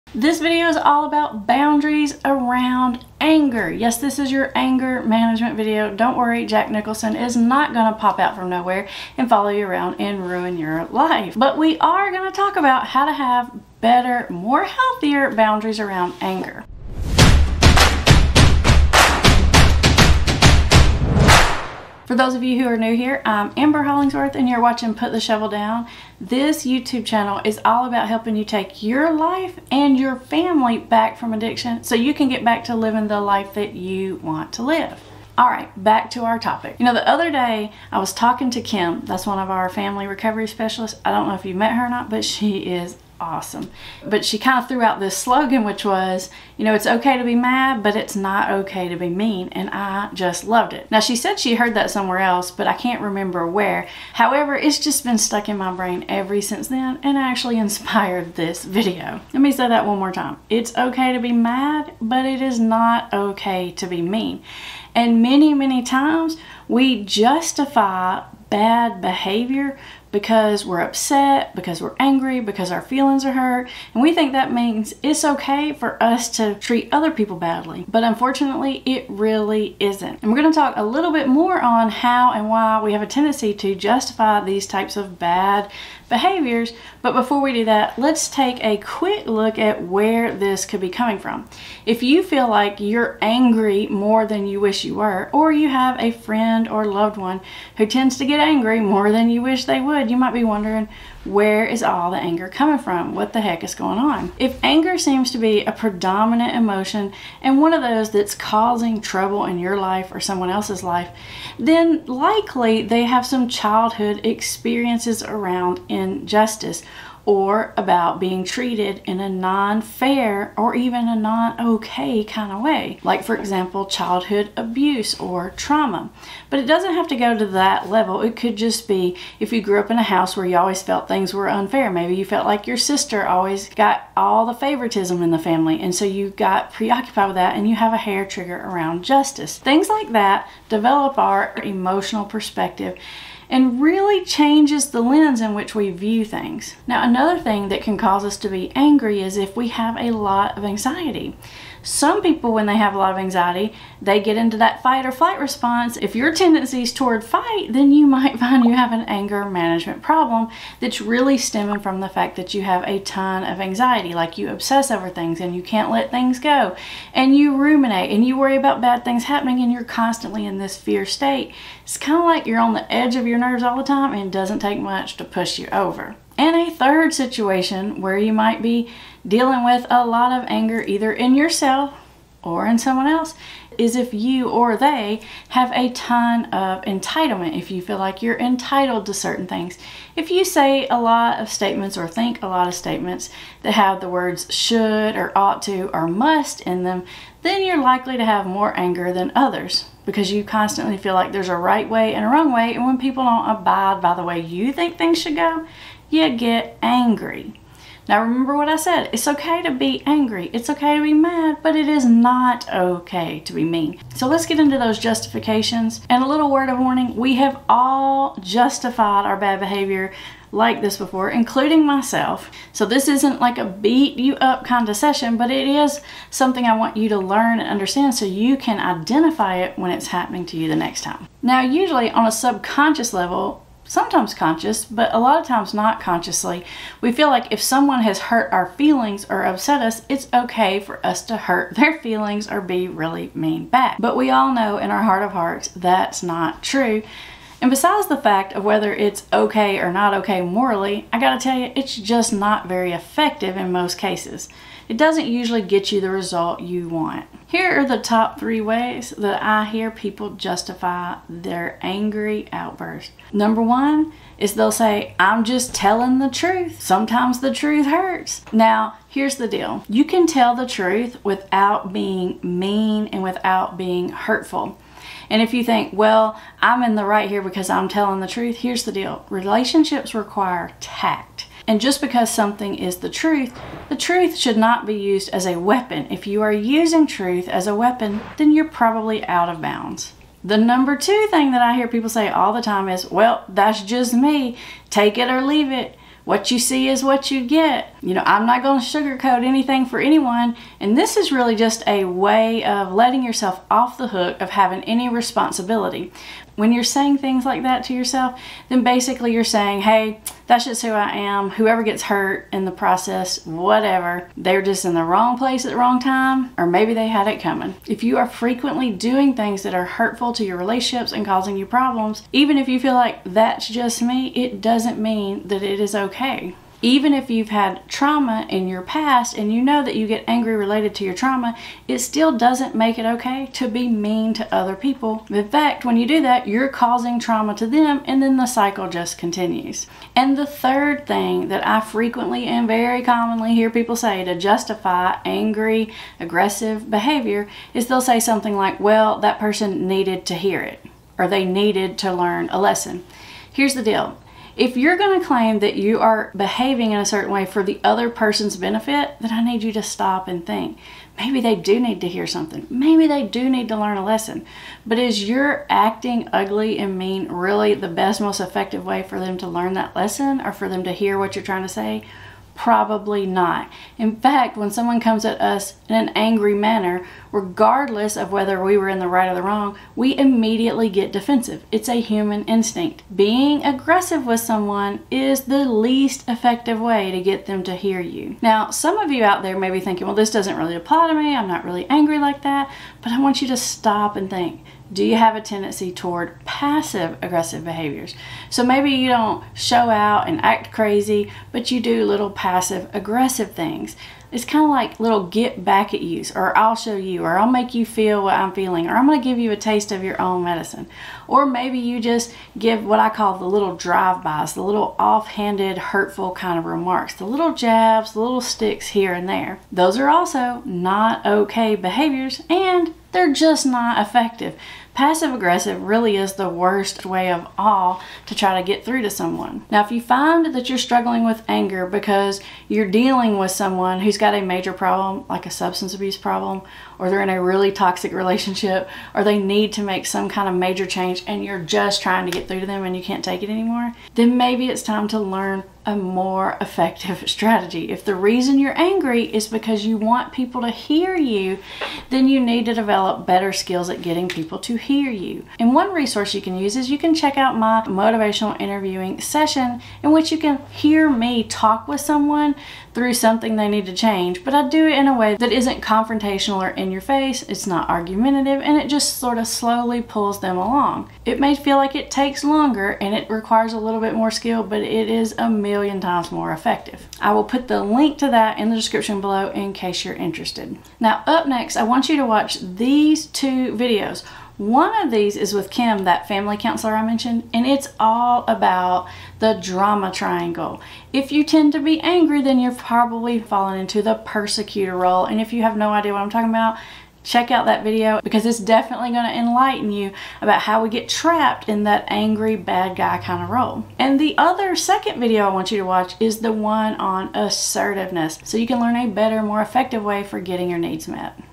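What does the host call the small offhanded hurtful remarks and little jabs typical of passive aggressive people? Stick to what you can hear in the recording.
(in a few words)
drive bys.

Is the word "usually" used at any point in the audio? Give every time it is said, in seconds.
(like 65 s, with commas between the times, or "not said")
231 s, 255 s.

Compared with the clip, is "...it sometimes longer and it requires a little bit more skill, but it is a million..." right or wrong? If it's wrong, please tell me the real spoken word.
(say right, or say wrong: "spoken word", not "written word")
wrong: "takes", not "sometimes".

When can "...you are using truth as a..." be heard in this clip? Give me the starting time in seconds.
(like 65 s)
286 s.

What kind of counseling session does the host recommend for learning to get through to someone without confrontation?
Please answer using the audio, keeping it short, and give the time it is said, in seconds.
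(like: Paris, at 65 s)
motivational interviewing, at 457 s.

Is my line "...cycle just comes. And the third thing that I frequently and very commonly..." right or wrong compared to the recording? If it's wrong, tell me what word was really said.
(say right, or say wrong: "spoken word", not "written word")
wrong: "continues", not "comes".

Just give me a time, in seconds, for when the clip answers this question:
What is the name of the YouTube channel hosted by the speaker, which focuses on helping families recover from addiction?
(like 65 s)
24 s.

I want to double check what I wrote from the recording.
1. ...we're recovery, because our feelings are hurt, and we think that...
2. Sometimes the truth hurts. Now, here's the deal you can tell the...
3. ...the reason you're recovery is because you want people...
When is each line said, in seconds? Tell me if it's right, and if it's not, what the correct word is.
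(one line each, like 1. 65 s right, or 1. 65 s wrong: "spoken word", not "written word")
1. 71 s wrong: "angry", not "recovery"
2. 266 s right
3. 448 s wrong: "angry", not "recovery".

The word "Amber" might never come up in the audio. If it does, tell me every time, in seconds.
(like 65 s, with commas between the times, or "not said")
23 s.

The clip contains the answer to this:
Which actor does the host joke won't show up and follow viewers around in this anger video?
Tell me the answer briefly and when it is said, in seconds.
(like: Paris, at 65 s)
Jack Nicholson, at 6 s.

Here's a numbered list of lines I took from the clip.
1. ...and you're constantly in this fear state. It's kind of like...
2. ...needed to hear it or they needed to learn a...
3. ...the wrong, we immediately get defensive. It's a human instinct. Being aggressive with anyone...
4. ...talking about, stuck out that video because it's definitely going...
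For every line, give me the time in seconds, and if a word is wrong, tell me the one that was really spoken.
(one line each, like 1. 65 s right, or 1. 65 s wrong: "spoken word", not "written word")
1. 169 s right
2. 349 s right
3. 379 s wrong: "someone", not "anyone"
4. 496 s wrong: "check", not "stuck".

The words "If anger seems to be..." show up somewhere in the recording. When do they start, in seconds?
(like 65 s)
104 s.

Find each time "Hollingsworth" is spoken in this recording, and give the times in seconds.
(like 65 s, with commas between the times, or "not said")
23 s.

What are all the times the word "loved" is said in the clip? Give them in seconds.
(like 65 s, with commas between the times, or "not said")
50 s, 96 s.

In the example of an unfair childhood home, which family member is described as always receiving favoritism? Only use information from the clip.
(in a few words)
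sister.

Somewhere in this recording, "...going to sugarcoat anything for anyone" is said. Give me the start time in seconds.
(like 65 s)
298 s.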